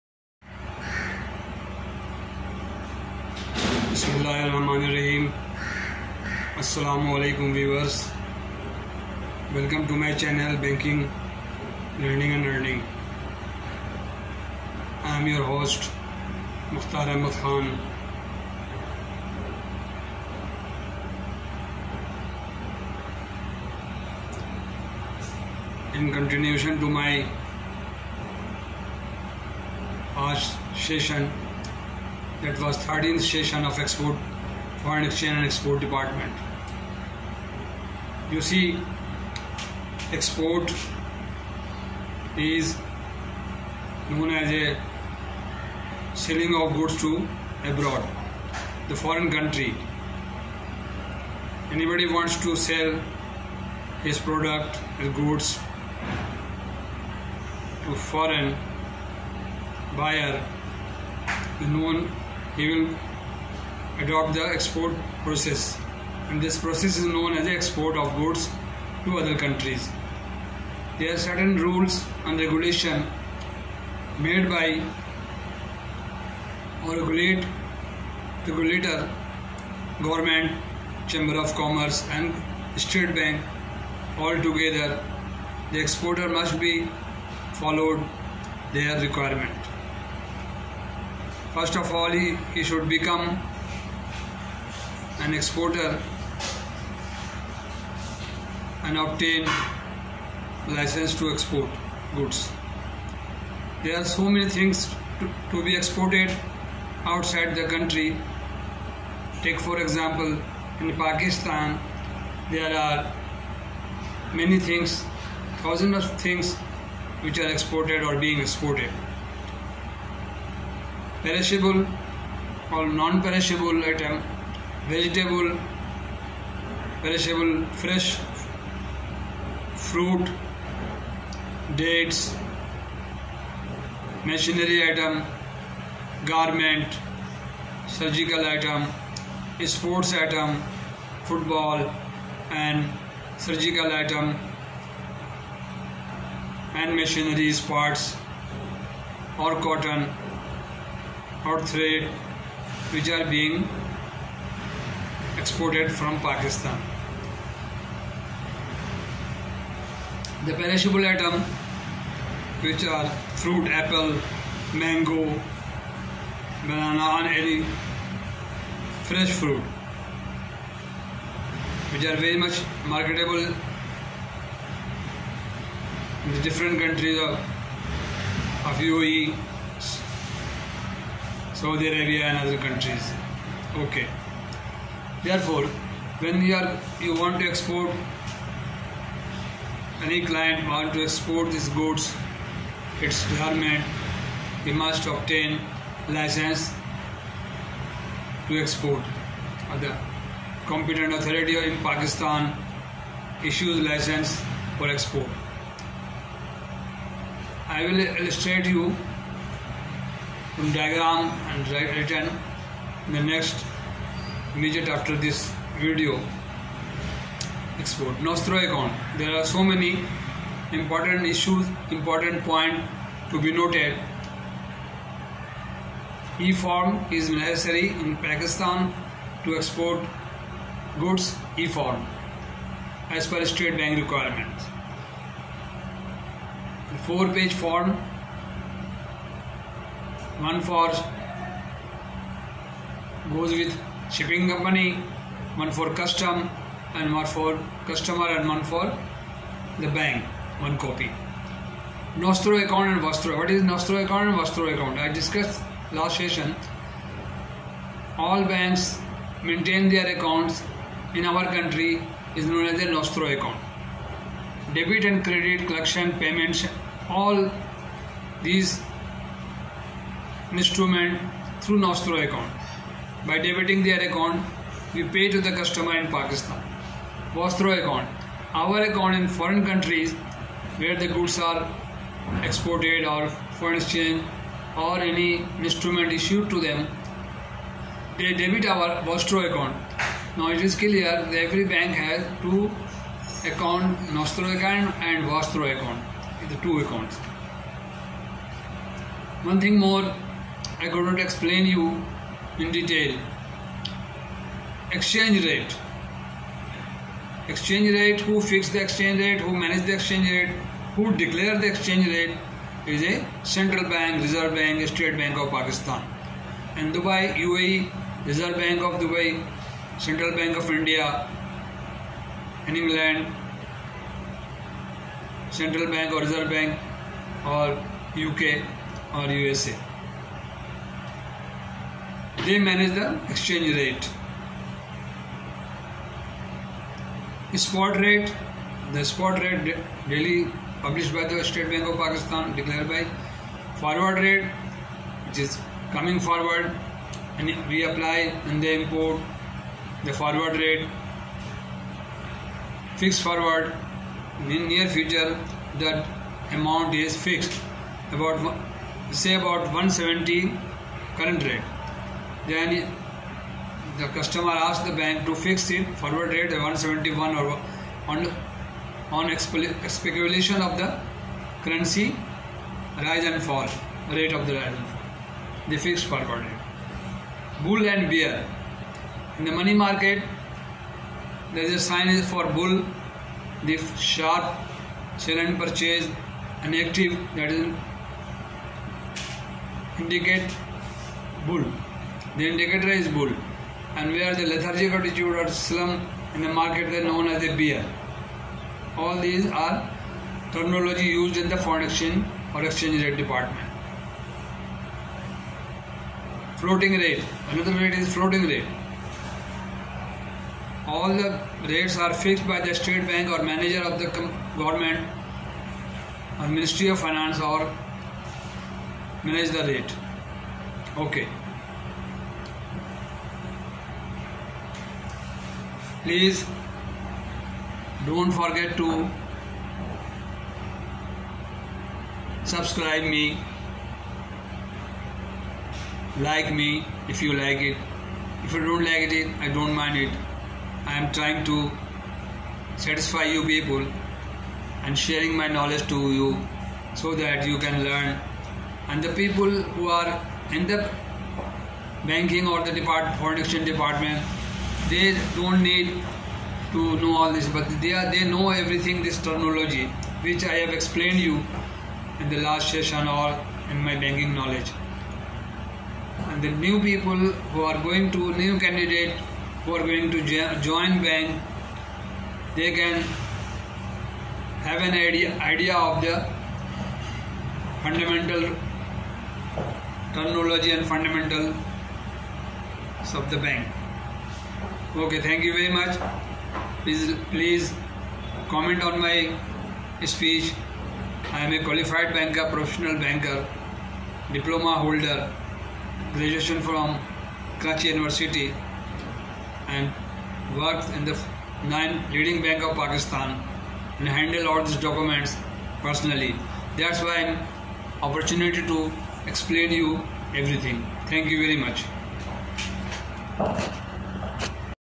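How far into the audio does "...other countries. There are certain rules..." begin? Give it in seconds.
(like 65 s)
69 s.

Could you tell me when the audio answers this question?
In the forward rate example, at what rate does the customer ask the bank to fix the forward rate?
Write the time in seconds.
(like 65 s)
366 s.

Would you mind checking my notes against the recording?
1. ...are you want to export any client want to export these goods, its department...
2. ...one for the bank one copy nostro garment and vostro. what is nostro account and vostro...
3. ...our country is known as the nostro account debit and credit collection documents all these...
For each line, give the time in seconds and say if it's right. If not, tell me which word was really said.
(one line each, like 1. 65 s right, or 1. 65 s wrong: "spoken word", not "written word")
1. 186 s wrong: "garment", not "department"
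2. 248 s wrong: "account", not "garment"
3. 261 s wrong: "payments", not "documents".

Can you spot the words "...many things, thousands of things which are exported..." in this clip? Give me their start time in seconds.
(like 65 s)
114 s.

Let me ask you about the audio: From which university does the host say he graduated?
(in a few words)
Karachi University.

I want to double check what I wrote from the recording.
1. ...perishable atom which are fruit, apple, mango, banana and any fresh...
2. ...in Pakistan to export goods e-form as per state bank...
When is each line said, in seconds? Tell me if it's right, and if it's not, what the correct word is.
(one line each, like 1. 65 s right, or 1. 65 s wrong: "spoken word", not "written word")
1. 160 s right
2. 228 s right.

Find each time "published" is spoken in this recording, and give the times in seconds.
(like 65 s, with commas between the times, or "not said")
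340 s.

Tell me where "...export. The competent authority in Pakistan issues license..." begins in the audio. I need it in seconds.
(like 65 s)
198 s.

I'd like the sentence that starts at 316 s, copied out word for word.
And Dubai, UAE, Reserve Bank of Dubai, Central Bank of India, and England, Central Bank or Reserve Bank or UK or USA.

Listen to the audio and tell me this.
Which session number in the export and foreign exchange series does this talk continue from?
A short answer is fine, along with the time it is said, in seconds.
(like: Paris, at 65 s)
13th, at 32 s.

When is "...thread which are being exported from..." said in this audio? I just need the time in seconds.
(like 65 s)
151 s.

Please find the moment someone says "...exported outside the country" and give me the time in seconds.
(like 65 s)
105 s.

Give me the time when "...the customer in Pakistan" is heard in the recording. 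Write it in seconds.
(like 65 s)
275 s.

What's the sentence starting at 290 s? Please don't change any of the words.
Now it is clear that every bank has two account, Nostro account and Vostro account, the two accounts.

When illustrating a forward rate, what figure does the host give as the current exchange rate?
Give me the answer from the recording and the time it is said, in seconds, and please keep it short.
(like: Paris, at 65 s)
170, at 359 s.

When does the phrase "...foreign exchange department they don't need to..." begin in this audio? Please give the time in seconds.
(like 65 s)
453 s.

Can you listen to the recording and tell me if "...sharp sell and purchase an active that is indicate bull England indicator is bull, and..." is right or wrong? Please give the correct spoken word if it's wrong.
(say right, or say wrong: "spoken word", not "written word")
wrong: "The", not "England".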